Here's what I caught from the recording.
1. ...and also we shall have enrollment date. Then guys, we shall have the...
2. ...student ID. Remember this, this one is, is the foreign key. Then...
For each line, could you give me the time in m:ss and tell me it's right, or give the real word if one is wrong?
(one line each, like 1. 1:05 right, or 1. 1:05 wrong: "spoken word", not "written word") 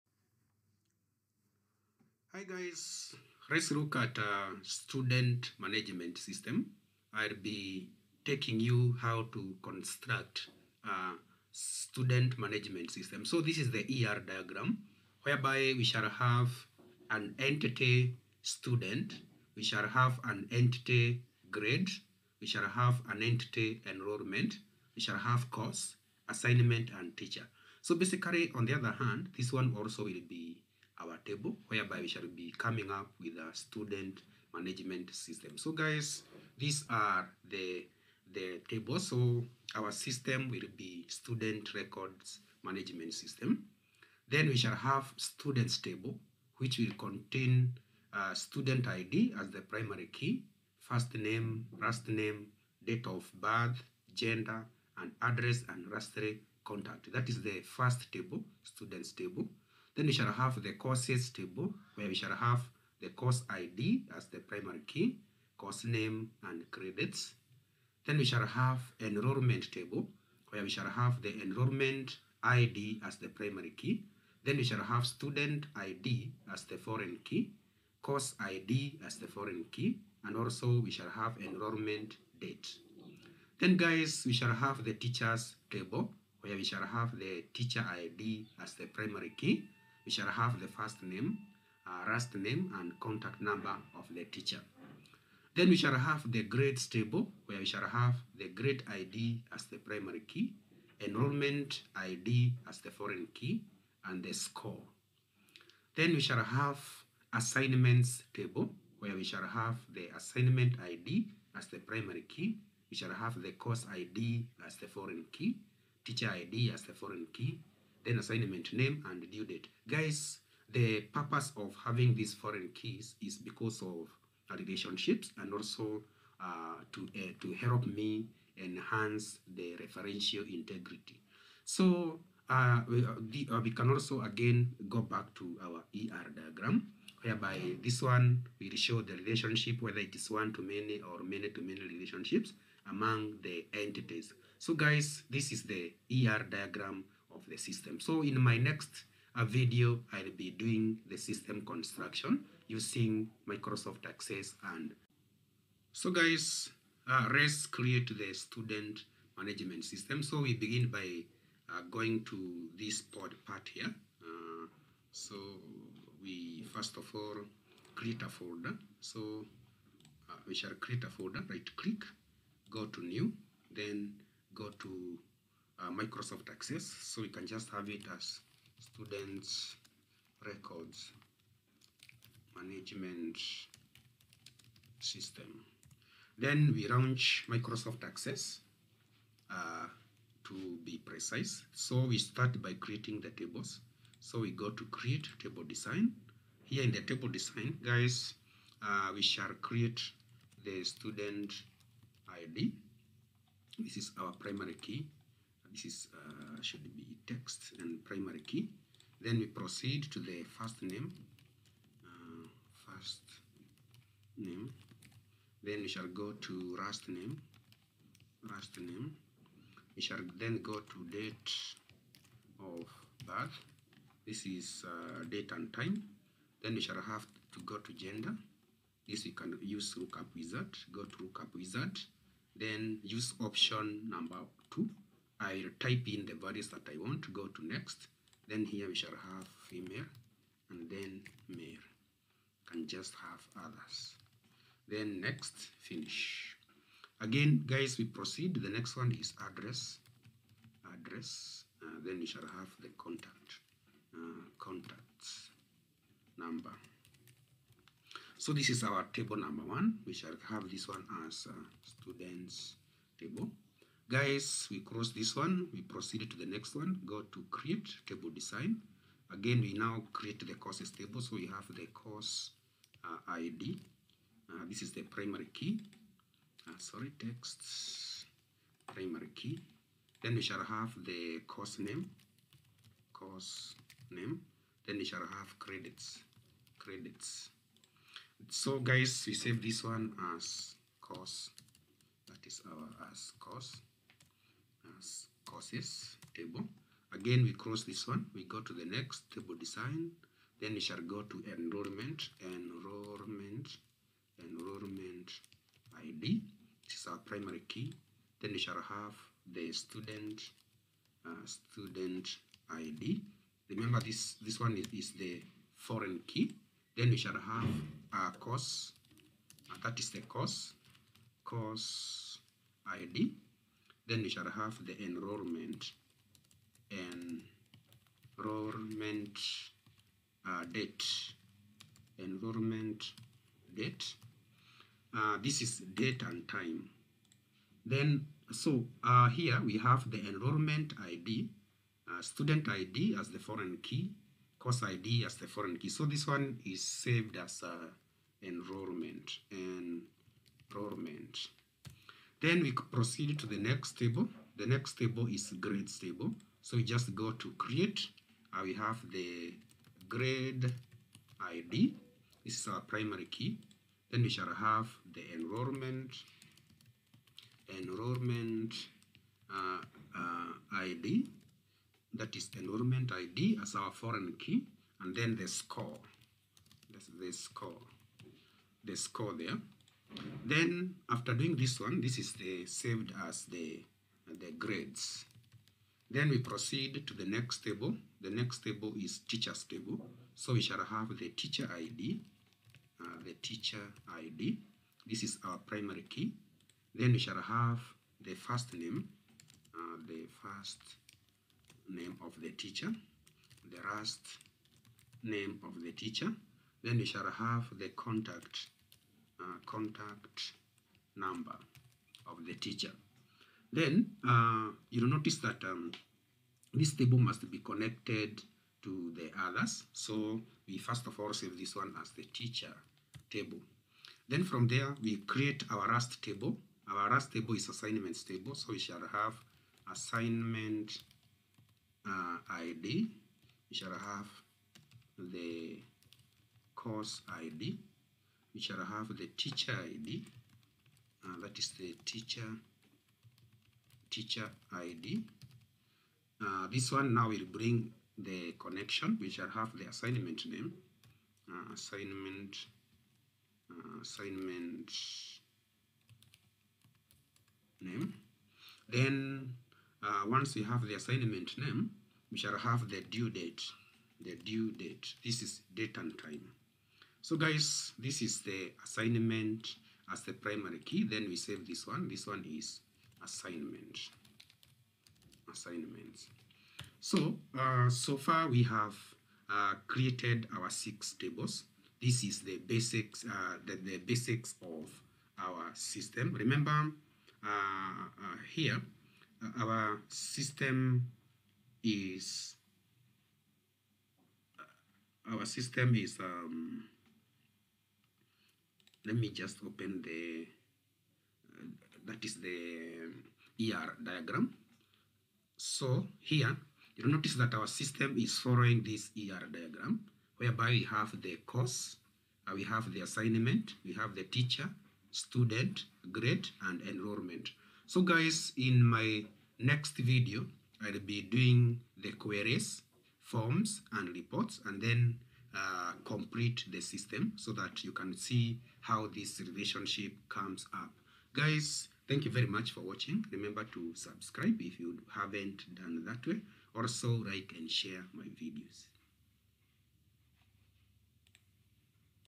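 1. 1:20 right
2. 5:11 right.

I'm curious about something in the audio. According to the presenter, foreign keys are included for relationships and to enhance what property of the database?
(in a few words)
referential integrity.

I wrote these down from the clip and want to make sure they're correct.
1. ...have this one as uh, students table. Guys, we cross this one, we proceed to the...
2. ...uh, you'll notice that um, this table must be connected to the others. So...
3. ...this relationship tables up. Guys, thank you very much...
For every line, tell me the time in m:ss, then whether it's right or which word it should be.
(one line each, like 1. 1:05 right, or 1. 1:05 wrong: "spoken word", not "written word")
1. 4:20 right
2. 6:54 right
3. 8:49 wrong: "comes", not "tables".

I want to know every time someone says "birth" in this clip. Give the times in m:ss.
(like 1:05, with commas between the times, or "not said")
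0:53, 3:43.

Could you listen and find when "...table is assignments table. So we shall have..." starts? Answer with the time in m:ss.
7:07.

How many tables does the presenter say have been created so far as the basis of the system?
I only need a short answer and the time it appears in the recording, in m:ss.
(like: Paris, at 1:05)
6, at 8:00.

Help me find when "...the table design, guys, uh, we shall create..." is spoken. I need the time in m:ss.
3:16.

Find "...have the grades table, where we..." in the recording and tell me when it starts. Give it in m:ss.
1:35.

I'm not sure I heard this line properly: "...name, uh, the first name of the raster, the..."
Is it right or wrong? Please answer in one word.
wrong.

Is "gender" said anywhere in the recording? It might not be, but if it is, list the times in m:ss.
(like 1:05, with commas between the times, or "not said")
0:54, 3:47.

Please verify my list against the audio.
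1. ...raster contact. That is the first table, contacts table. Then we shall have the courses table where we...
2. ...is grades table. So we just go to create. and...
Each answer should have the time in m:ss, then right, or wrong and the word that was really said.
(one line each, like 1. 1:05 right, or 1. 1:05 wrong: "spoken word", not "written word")
1. 0:55 wrong: "students", not "contacts"
2. 5:55 right.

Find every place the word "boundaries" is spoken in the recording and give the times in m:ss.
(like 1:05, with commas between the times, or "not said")
not said.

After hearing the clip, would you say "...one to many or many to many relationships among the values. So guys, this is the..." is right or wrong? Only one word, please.
wrong.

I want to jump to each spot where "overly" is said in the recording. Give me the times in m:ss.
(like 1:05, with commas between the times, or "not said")
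not said.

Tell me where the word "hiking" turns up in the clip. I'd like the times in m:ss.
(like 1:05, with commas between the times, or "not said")
not said.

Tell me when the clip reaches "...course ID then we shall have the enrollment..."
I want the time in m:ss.
5:21.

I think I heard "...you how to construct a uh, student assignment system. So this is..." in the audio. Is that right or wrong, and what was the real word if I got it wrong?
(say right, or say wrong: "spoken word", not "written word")
wrong: "management", not "assignment".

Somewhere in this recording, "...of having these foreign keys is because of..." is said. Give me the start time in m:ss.
2:01.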